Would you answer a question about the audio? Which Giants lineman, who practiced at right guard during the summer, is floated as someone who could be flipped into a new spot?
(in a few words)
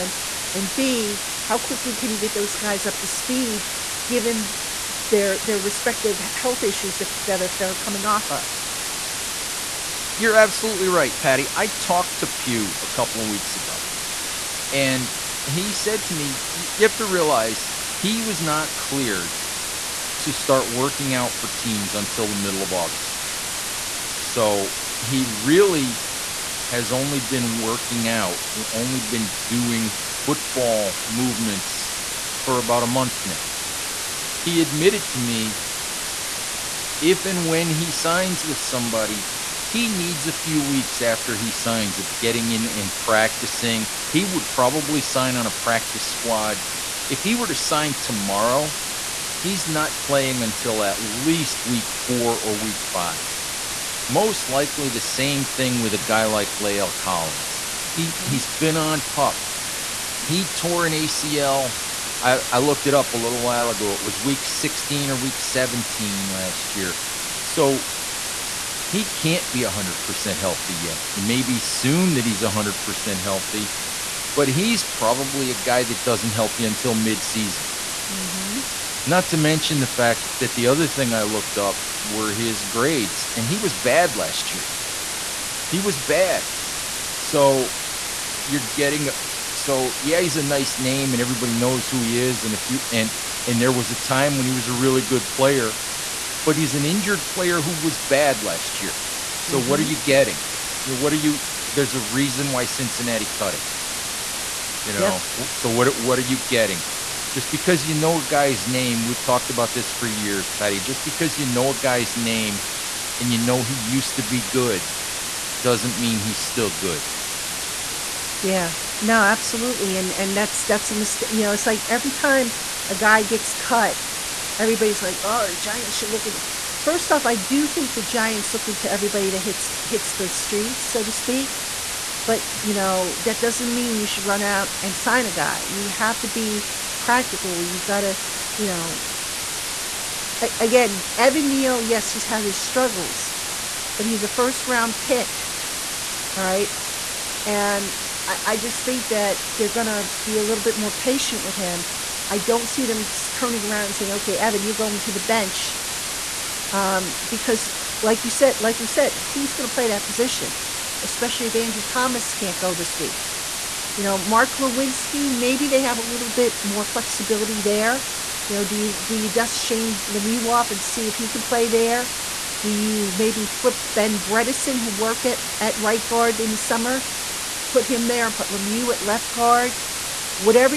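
Ben Bredeson.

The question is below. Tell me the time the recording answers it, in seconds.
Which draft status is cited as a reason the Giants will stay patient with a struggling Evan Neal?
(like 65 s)
144 s.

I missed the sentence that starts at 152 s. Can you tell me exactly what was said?
I don't see them turning around and saying, okay, Evan, you're going to the bench.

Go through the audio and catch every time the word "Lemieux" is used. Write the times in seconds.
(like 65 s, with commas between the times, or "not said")
170 s, 178 s.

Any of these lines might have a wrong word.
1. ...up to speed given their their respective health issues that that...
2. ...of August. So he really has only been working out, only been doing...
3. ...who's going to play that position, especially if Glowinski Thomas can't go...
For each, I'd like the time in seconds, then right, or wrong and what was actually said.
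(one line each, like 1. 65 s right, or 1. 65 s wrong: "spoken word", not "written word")
1. 2 s right
2. 22 s right
3. 159 s wrong: "Andrew", not "Glowinski".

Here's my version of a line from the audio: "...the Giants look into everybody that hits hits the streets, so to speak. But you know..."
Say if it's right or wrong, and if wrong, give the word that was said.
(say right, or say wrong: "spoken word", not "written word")
right.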